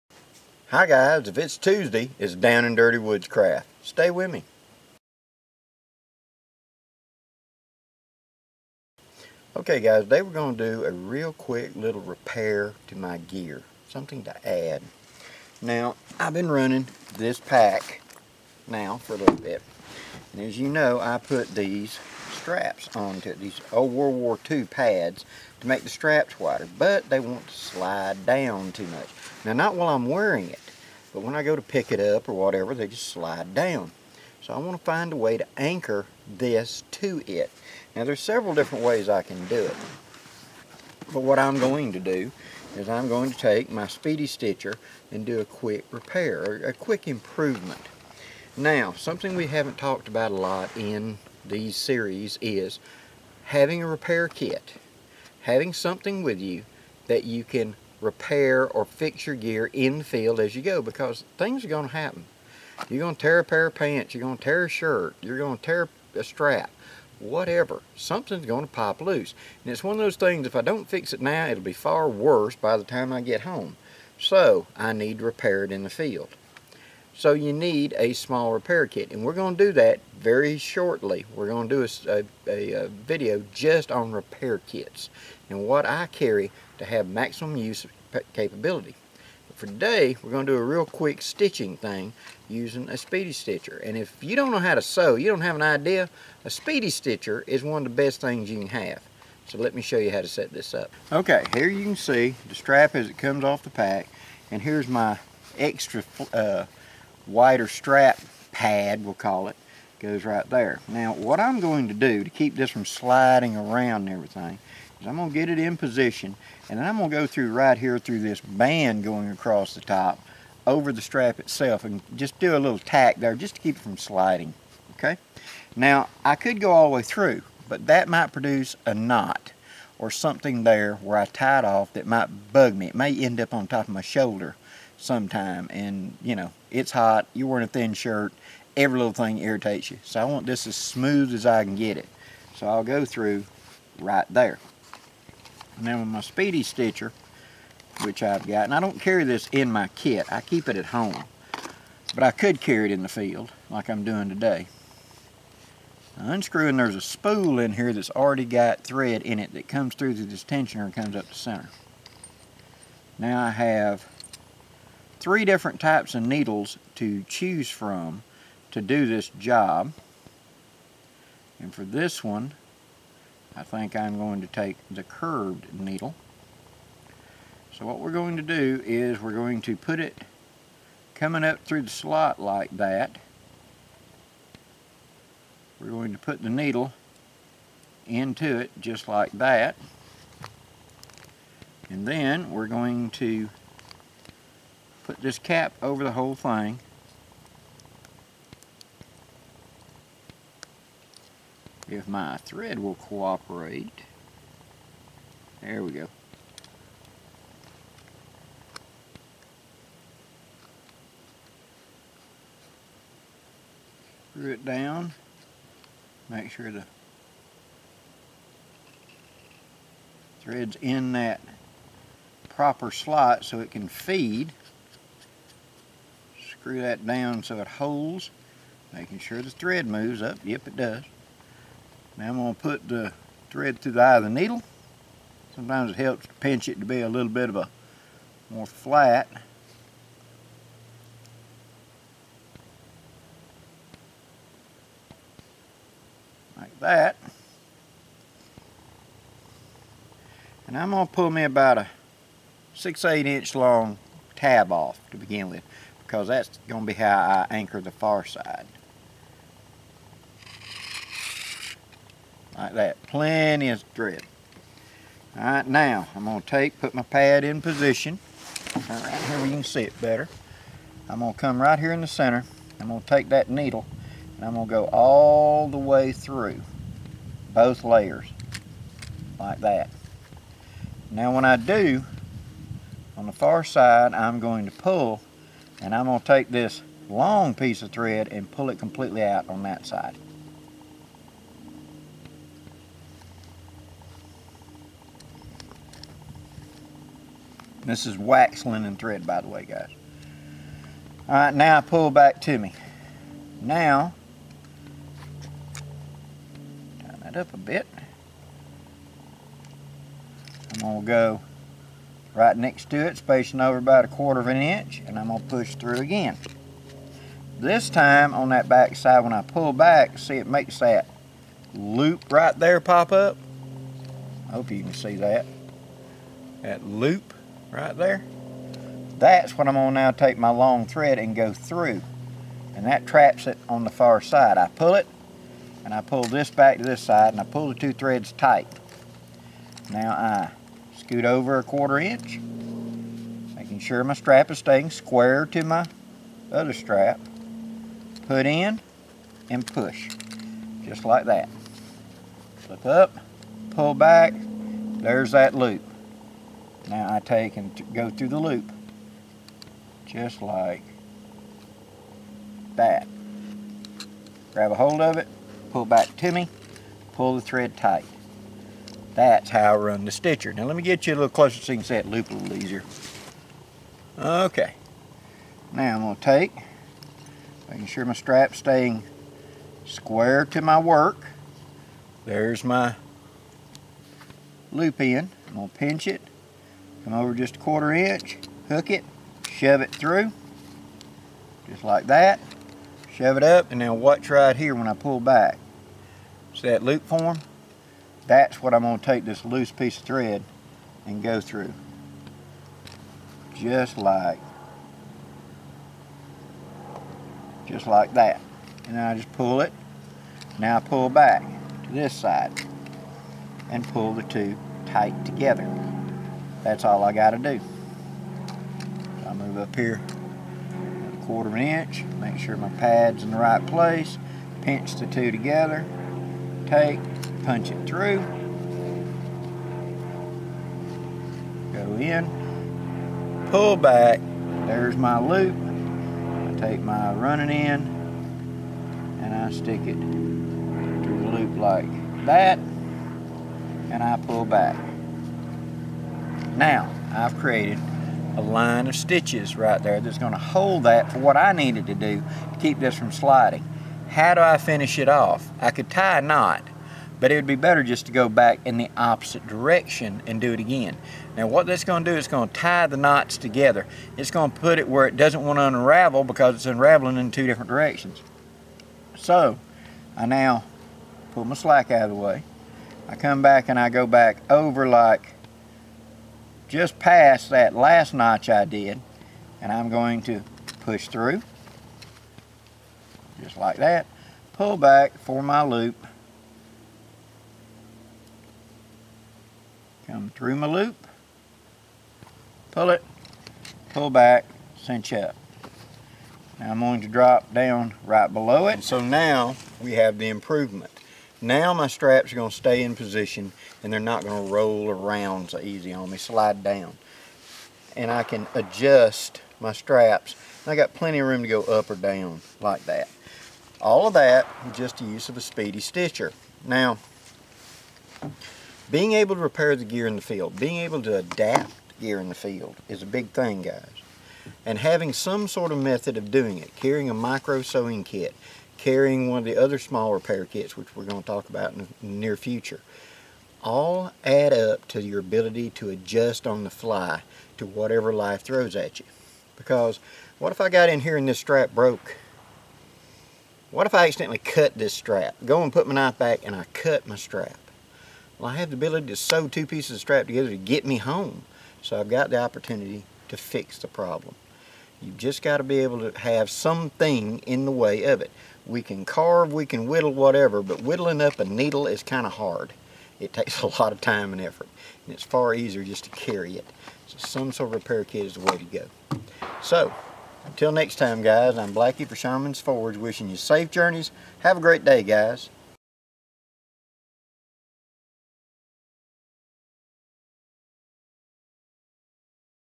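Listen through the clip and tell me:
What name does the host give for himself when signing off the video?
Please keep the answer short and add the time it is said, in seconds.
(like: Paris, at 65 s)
Blackie, at 571 s.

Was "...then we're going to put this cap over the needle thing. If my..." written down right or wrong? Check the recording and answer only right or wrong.
wrong.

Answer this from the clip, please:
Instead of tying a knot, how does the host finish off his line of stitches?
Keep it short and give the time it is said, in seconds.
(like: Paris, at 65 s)
go back in the opposite direction, at 458 s.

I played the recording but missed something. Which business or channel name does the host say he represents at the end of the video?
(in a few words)
Sherman's Forge.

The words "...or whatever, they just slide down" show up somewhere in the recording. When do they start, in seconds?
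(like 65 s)
32 s.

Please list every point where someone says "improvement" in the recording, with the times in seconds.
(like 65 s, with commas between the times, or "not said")
47 s, 500 s.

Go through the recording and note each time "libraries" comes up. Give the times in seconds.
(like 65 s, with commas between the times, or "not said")
not said.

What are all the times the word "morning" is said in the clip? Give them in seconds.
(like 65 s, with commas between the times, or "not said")
not said.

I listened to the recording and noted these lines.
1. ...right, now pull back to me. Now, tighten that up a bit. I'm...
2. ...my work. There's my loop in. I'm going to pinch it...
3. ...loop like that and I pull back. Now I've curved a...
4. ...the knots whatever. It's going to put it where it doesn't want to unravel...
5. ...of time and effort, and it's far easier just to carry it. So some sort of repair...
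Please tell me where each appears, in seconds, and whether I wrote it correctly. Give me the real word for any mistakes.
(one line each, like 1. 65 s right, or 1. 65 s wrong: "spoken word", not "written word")
1. 301 s right
2. 380 s right
3. 441 s wrong: "created", not "curved"
4. 462 s wrong: "together", not "whatever"
5. 563 s right.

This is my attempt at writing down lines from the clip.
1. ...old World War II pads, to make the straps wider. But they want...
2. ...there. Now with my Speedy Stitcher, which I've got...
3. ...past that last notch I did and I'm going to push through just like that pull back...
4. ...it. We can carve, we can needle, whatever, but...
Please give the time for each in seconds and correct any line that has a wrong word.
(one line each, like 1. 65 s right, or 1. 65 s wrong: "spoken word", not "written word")
1. 23 s right
2. 144 s right
3. 476 s right
4. 558 s wrong: "whittle", not "needle".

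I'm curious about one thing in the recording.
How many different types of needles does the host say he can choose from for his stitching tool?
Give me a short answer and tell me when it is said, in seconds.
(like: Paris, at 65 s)
3, at 165 s.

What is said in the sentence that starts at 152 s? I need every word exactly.
But I could carry it in the field, like I'm doing today.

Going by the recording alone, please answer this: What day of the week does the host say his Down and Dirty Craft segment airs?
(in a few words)
Tuesday.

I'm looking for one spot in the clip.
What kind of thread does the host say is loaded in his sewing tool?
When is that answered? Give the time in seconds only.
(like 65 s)
298 s.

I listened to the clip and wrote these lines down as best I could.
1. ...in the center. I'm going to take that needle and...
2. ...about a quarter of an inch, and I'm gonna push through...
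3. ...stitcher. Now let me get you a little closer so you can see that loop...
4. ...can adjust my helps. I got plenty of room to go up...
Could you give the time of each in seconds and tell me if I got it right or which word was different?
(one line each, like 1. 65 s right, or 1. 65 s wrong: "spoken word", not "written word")
1. 271 s right
2. 313 s right
3. 370 s right
4. 508 s wrong: "straps", not "helps".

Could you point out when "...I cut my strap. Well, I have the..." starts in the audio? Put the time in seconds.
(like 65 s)
546 s.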